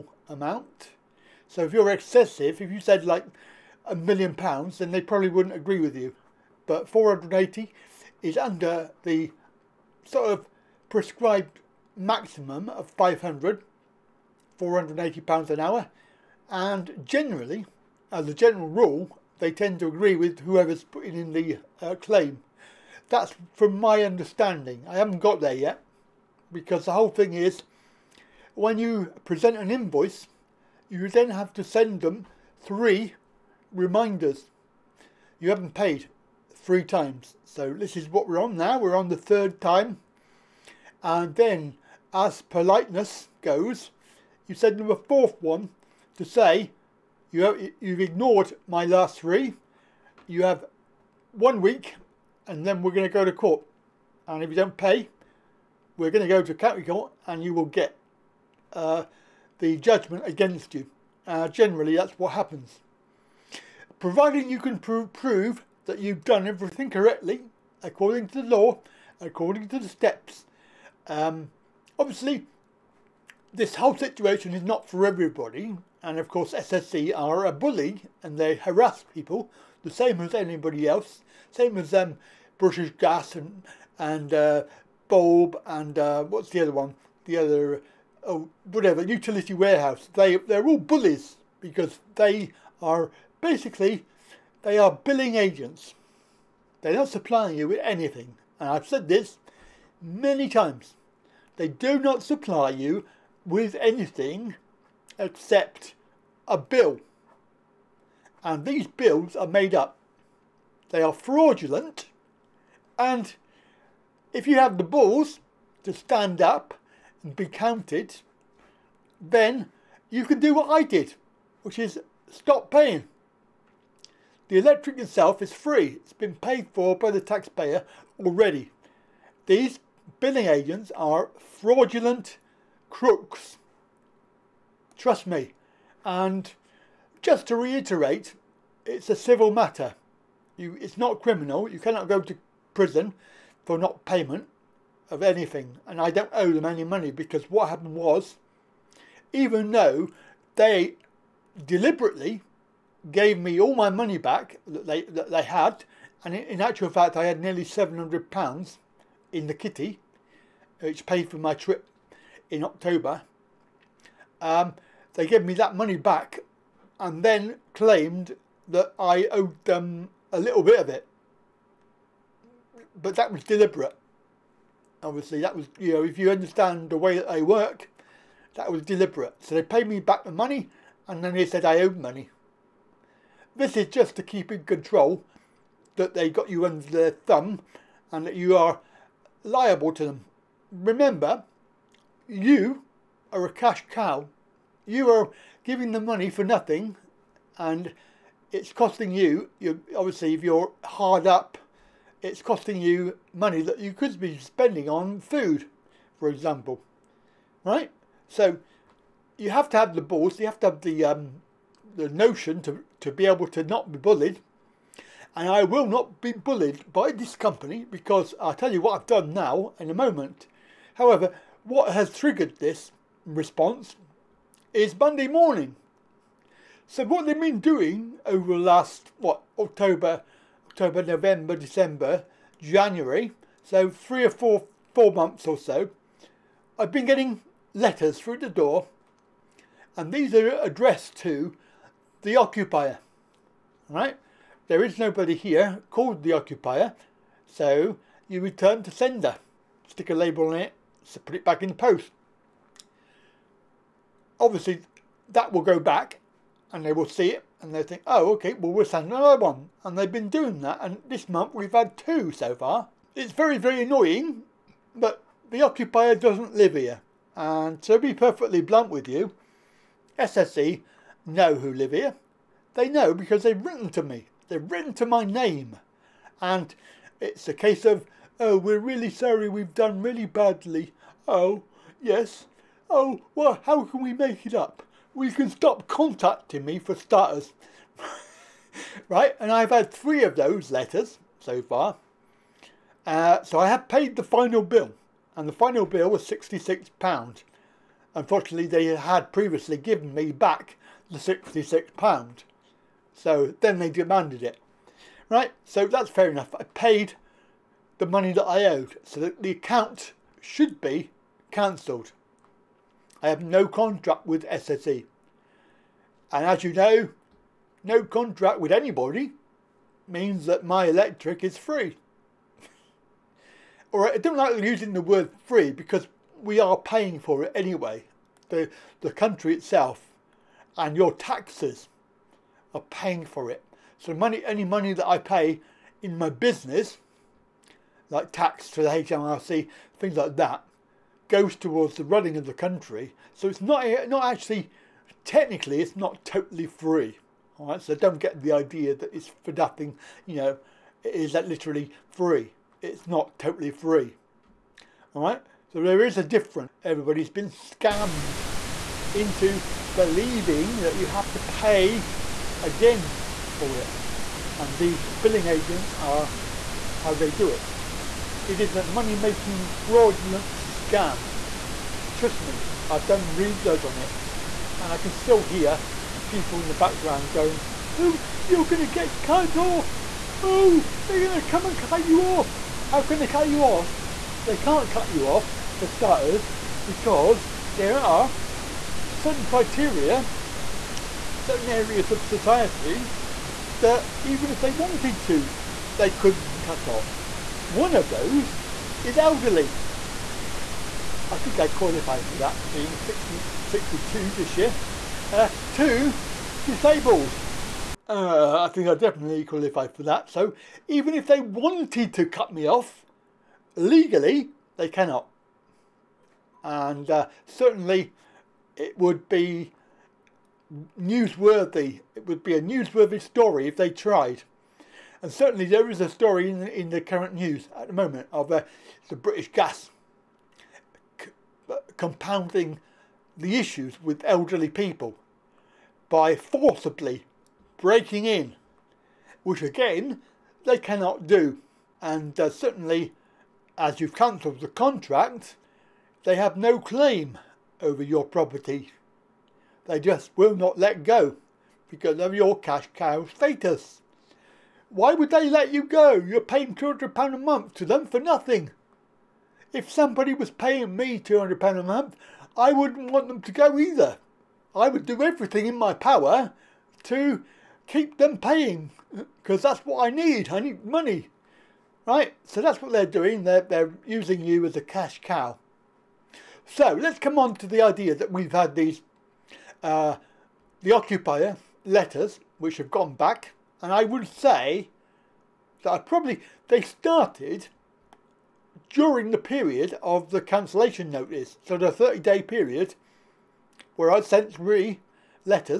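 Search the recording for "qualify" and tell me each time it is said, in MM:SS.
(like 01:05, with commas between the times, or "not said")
06:41, 06:49.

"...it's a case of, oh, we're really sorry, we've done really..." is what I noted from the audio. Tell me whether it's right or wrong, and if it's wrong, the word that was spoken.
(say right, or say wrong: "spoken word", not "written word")
right.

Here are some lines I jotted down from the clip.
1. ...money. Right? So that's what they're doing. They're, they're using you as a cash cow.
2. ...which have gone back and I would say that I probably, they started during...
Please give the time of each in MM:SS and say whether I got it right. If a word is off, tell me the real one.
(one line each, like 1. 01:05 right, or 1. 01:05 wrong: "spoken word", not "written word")
1. 07:50 right
2. 08:02 right.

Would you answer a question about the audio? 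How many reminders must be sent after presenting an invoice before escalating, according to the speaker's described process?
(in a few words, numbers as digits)
3.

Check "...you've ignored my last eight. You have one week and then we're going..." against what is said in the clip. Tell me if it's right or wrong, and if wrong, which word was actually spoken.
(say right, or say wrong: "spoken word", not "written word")
wrong: "three", not "eight".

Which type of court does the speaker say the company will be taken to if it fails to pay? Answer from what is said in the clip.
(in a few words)
county court.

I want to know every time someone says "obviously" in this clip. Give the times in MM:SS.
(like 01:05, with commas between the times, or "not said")
01:11, 02:55, 03:19, 04:14.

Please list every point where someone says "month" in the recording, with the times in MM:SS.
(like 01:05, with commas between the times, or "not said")
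03:55, 04:21, 07:37, 07:41.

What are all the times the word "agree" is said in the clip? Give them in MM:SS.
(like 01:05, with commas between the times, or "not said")
00:05, 00:19.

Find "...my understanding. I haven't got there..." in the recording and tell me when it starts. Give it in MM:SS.
00:23.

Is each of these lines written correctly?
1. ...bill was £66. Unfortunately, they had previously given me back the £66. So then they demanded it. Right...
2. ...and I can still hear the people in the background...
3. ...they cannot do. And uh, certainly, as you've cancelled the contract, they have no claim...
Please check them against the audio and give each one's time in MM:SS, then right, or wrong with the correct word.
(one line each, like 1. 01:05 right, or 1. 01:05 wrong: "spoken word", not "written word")
1. 04:55 right
2. 06:14 right
3. 07:20 right.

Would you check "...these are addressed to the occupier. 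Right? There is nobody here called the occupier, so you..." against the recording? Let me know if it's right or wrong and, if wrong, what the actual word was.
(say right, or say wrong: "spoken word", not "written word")
right.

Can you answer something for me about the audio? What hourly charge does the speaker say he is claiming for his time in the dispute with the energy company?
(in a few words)
£480.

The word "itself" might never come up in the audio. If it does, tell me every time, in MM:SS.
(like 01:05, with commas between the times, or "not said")
02:04, 05:29.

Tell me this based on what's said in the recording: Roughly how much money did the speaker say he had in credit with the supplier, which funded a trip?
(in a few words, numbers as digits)
nearly £700.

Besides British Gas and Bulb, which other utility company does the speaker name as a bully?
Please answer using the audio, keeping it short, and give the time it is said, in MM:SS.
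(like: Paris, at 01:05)
Utility Warehouse, at 01:29.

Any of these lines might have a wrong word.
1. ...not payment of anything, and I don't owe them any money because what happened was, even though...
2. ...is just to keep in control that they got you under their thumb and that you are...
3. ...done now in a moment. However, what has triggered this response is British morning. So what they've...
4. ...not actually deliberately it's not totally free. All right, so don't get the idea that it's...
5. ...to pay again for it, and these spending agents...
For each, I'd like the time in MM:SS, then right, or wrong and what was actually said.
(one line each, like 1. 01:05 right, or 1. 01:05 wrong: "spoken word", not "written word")
1. 02:23 right
2. 03:03 right
3. 03:39 wrong: "Monday", not "British"
4. 05:44 wrong: "technically", not "deliberately"
5. 06:01 wrong: "billing", not "spending".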